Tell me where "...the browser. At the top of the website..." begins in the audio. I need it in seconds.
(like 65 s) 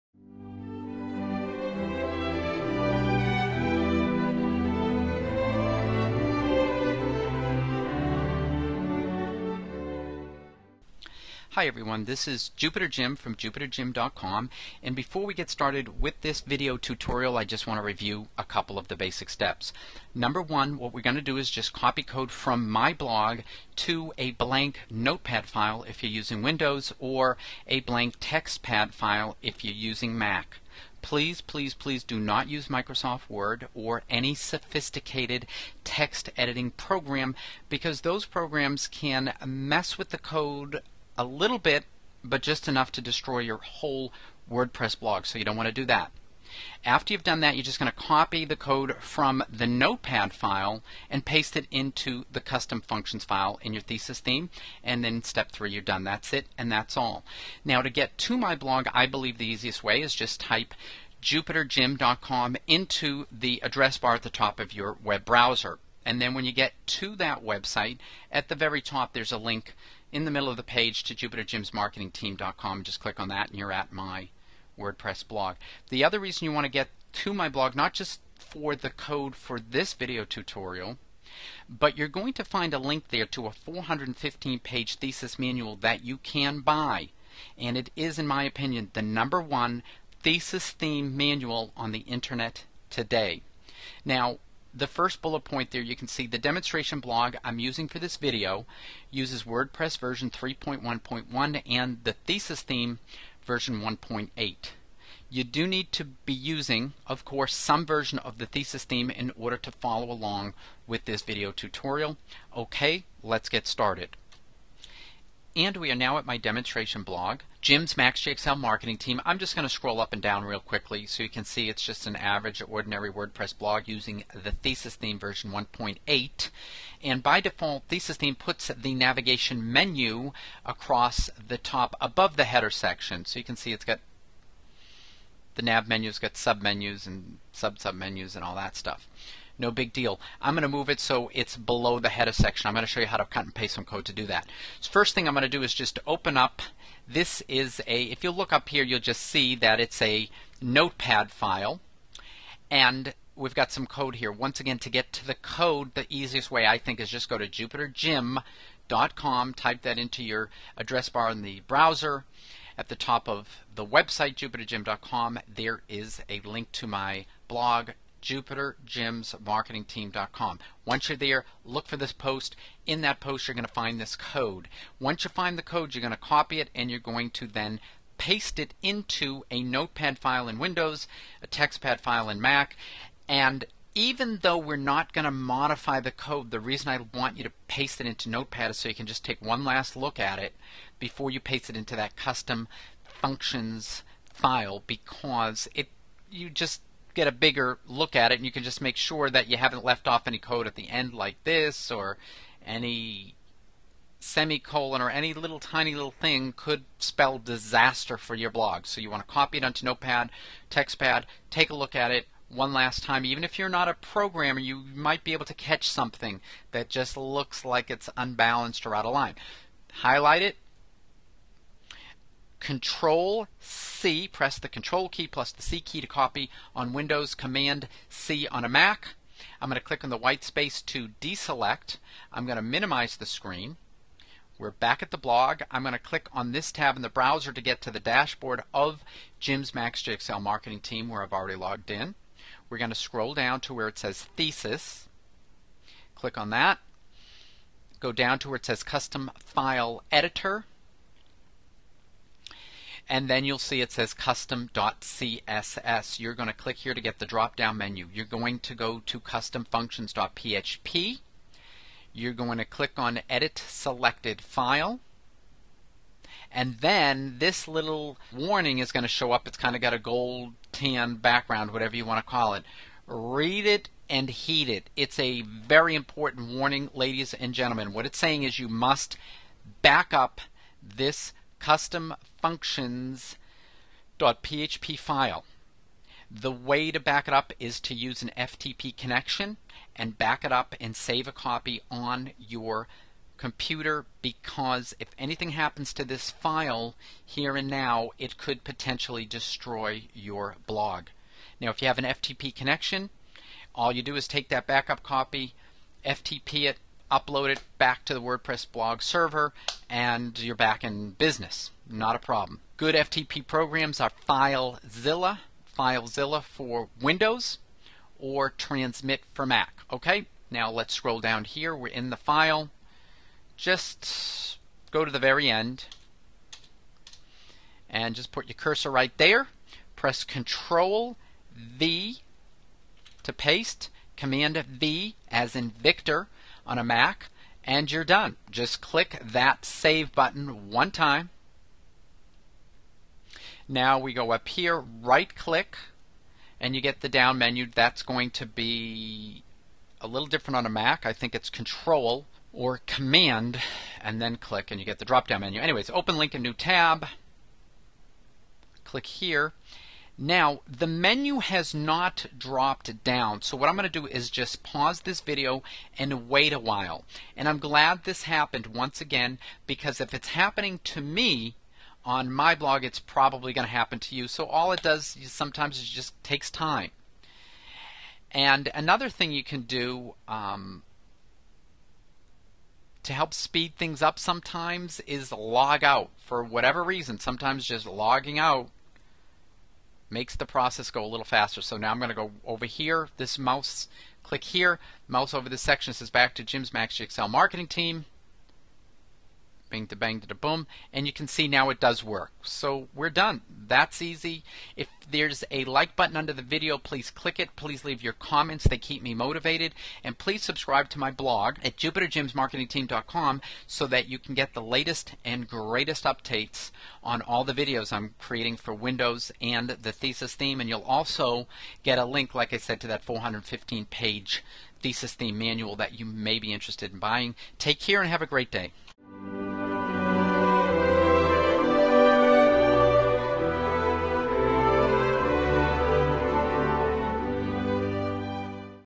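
161 s.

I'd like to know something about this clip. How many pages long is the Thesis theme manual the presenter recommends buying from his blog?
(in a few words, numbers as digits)
415.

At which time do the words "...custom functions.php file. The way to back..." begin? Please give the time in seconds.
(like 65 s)
281 s.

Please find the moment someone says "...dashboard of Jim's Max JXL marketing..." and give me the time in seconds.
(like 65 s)
237 s.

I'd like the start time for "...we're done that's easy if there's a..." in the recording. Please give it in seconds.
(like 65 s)
402 s.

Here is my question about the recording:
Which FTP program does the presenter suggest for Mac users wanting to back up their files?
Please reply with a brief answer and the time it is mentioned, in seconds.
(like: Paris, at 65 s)
Transmit, at 318 s.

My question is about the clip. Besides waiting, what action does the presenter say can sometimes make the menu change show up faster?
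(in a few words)
Logging out.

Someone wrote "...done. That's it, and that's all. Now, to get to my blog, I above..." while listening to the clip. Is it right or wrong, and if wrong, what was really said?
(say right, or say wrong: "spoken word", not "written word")
wrong: "believe", not "above".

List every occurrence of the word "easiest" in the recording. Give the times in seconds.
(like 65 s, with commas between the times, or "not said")
59 s, 156 s.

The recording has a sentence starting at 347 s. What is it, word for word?
That's going to be a little different on a Mac.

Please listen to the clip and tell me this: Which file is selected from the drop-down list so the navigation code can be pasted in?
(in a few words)
customfunctions.php.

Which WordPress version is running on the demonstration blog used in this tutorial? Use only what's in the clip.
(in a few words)
3.1.1.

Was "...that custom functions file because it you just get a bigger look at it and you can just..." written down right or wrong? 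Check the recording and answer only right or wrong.
right.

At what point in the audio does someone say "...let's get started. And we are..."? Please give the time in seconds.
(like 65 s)
113 s.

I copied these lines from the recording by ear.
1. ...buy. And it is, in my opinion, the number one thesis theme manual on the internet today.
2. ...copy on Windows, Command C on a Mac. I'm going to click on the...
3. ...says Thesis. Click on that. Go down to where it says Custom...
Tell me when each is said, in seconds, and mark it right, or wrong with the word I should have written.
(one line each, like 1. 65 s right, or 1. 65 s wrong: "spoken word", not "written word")
1. 86 s right
2. 226 s right
3. 243 s right.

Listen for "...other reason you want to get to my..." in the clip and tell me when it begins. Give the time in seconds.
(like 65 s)
76 s.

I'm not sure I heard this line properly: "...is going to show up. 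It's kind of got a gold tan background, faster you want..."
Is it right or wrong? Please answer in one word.
wrong.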